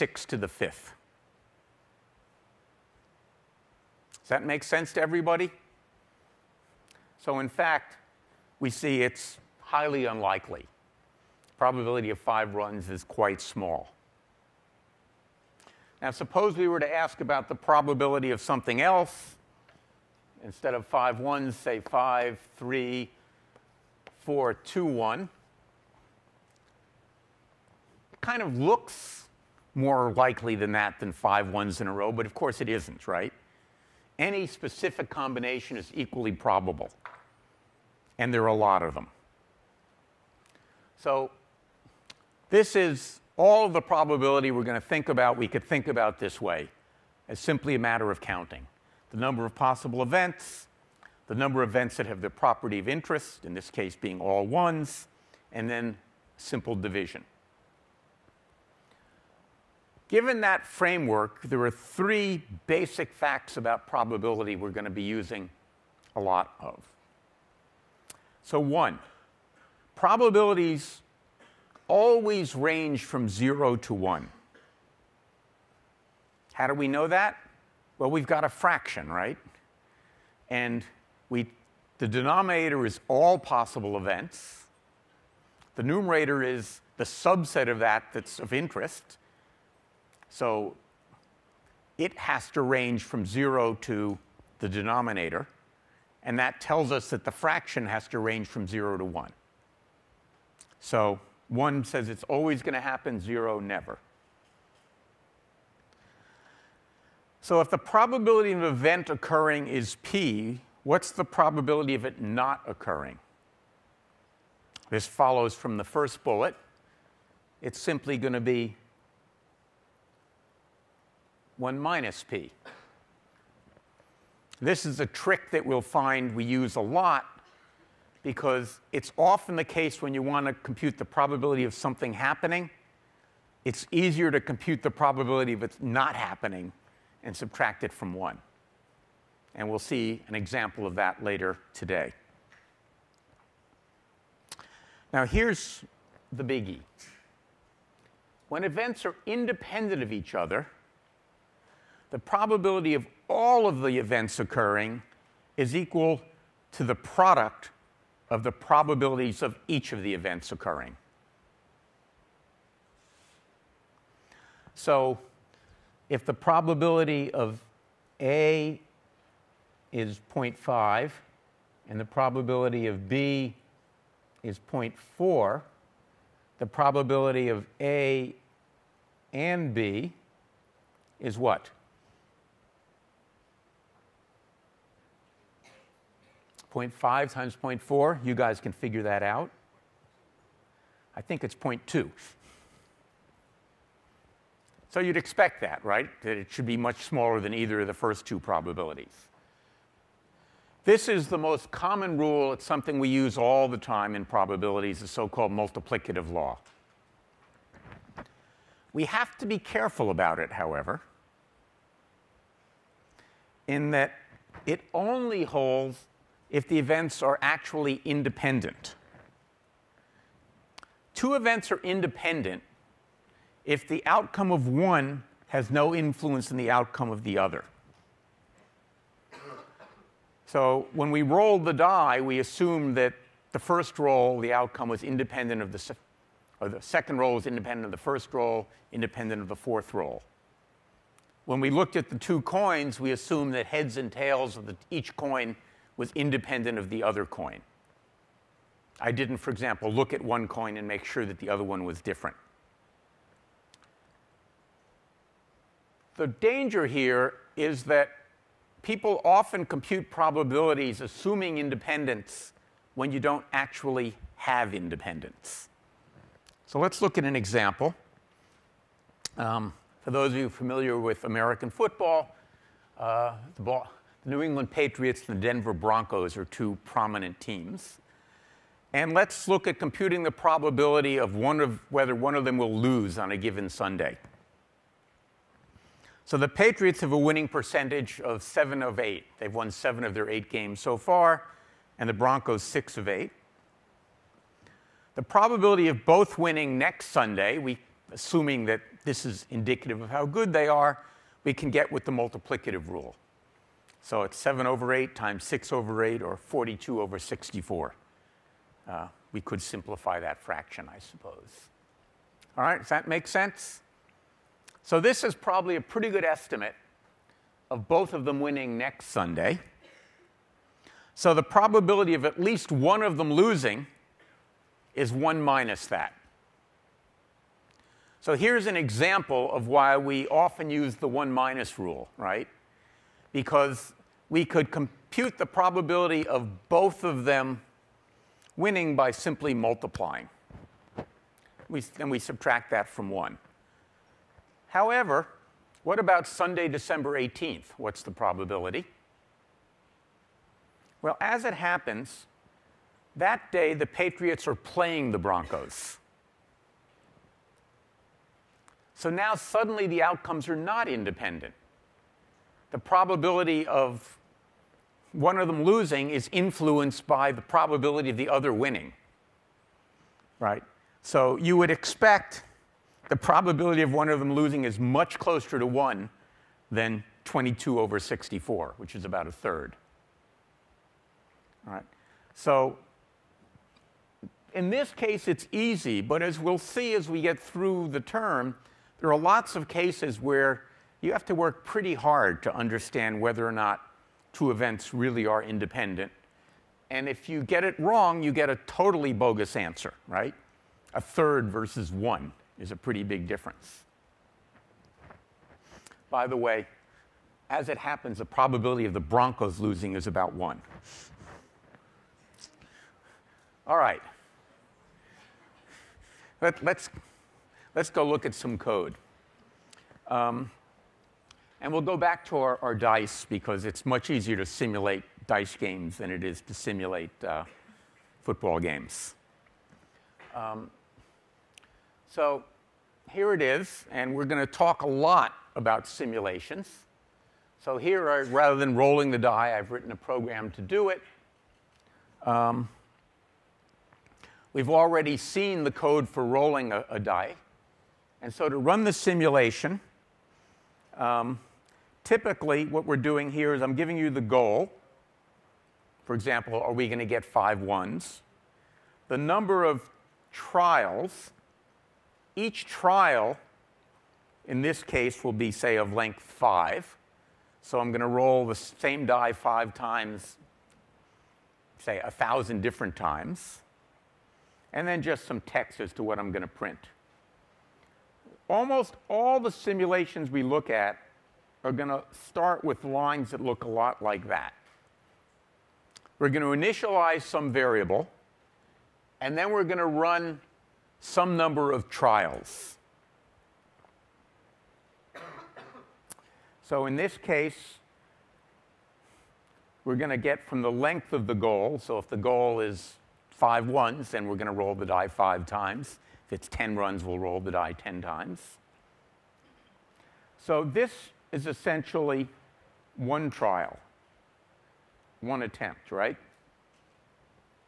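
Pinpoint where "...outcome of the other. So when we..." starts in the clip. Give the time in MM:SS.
03:46.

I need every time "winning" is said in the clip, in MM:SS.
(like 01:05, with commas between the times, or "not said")
04:47, 04:56, 05:18, 05:38, 06:08.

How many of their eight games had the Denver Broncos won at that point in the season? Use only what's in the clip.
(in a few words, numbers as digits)
6.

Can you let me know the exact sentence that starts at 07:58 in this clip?
Almost all the simulations we look at are going to start with lines that look a lot like that.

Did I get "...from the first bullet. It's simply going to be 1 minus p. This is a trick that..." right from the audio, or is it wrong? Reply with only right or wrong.
right.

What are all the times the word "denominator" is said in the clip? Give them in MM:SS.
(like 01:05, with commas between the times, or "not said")
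01:22, 01:34.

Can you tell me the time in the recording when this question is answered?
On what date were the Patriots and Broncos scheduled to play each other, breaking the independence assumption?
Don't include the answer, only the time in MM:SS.
05:46.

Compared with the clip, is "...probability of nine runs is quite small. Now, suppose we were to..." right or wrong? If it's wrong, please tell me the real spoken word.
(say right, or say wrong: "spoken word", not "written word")
wrong: "five", not "nine".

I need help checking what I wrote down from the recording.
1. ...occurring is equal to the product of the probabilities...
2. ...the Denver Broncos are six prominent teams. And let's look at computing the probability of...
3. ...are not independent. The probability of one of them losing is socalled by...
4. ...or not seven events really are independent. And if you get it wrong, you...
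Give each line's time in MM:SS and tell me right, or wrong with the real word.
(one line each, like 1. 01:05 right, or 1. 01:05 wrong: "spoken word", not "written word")
1. 02:34 right
2. 04:35 wrong: "two", not "six"
3. 06:00 wrong: "influenced", not "socalled"
4. 06:33 wrong: "two", not "seven".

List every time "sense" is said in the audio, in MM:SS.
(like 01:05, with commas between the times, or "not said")
00:04, 05:13.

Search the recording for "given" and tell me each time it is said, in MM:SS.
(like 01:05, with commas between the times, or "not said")
01:00, 04:43.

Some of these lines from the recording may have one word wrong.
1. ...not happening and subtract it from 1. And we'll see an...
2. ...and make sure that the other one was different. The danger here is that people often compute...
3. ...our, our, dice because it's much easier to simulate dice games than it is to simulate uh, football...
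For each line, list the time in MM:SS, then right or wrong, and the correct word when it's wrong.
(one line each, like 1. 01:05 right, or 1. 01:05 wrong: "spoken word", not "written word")
1. 02:15 right
2. 04:10 right
3. 07:02 right.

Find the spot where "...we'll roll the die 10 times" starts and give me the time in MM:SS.
08:27.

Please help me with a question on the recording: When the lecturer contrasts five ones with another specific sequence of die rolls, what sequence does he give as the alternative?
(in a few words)
5, 3, 4, 2, 1.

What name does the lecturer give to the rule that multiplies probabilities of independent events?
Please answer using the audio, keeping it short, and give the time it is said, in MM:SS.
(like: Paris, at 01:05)
multiplicative law, at 03:25.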